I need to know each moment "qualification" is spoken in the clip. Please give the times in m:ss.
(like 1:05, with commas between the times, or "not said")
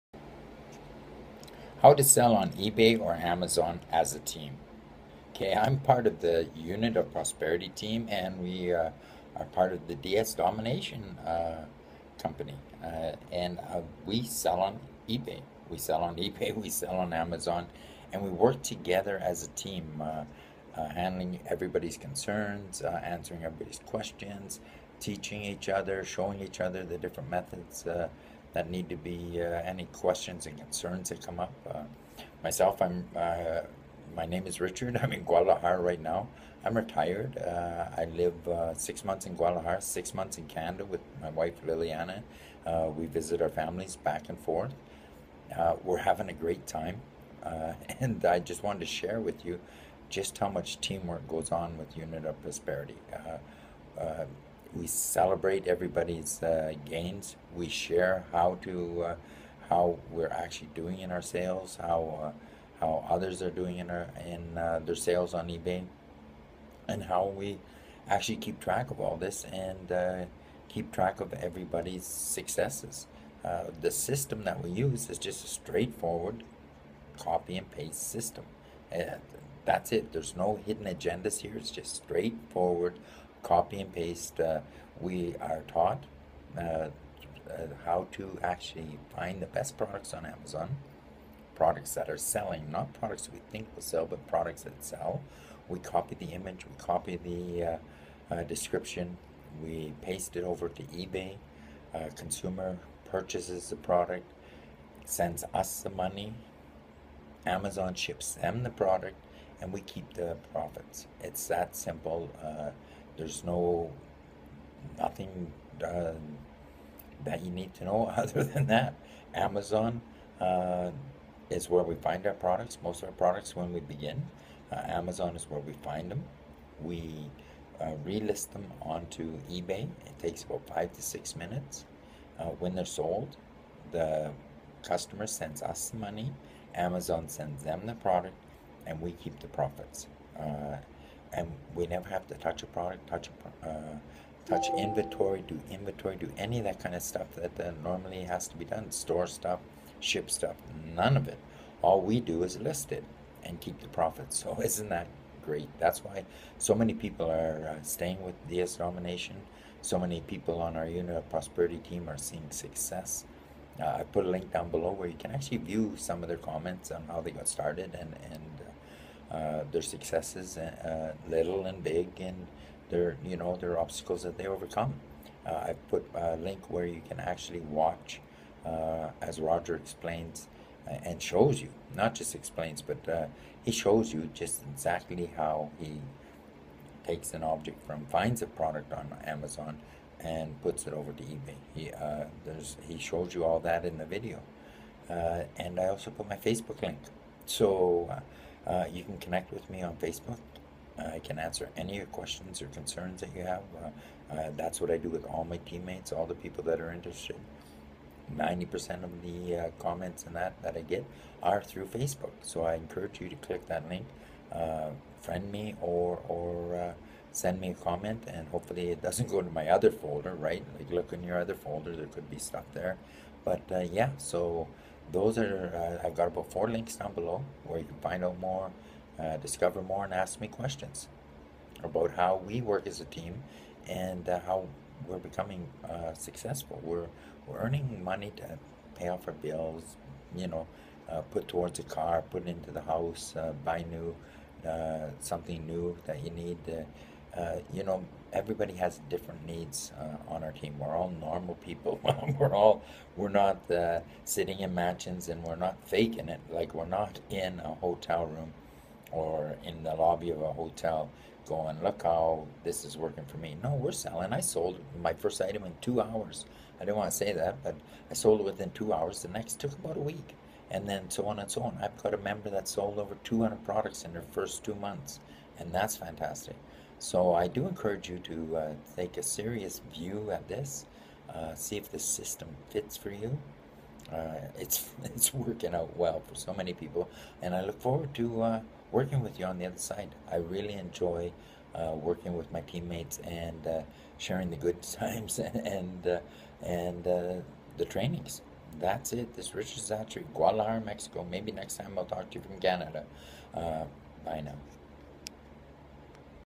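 not said.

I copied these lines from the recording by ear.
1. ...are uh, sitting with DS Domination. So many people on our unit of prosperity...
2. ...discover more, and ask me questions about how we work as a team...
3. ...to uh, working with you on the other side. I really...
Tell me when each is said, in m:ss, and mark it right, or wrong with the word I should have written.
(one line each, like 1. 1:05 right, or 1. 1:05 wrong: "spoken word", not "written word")
1. 2:37 wrong: "staying", not "sitting"
2. 3:49 right
3. 4:48 right.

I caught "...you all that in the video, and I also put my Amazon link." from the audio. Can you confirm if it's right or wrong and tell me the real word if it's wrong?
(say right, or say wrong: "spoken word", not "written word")
wrong: "Facebook", not "Amazon".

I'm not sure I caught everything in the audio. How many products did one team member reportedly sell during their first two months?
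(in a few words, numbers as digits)
over 200.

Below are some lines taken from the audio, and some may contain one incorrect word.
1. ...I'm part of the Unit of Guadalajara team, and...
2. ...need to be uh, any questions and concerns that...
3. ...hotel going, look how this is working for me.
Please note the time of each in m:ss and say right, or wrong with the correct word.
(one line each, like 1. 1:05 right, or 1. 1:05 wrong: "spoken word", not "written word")
1. 0:05 wrong: "Prosperity", not "Guadalajara"
2. 0:28 right
3. 4:20 right.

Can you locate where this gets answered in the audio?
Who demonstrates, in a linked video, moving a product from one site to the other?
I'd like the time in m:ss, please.
2:59.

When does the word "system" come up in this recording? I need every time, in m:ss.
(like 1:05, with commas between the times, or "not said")
1:13, 1:18, 4:41.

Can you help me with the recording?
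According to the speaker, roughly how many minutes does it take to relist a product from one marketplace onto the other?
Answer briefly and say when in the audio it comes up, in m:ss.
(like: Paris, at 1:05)
5 to 6 minutes, at 2:10.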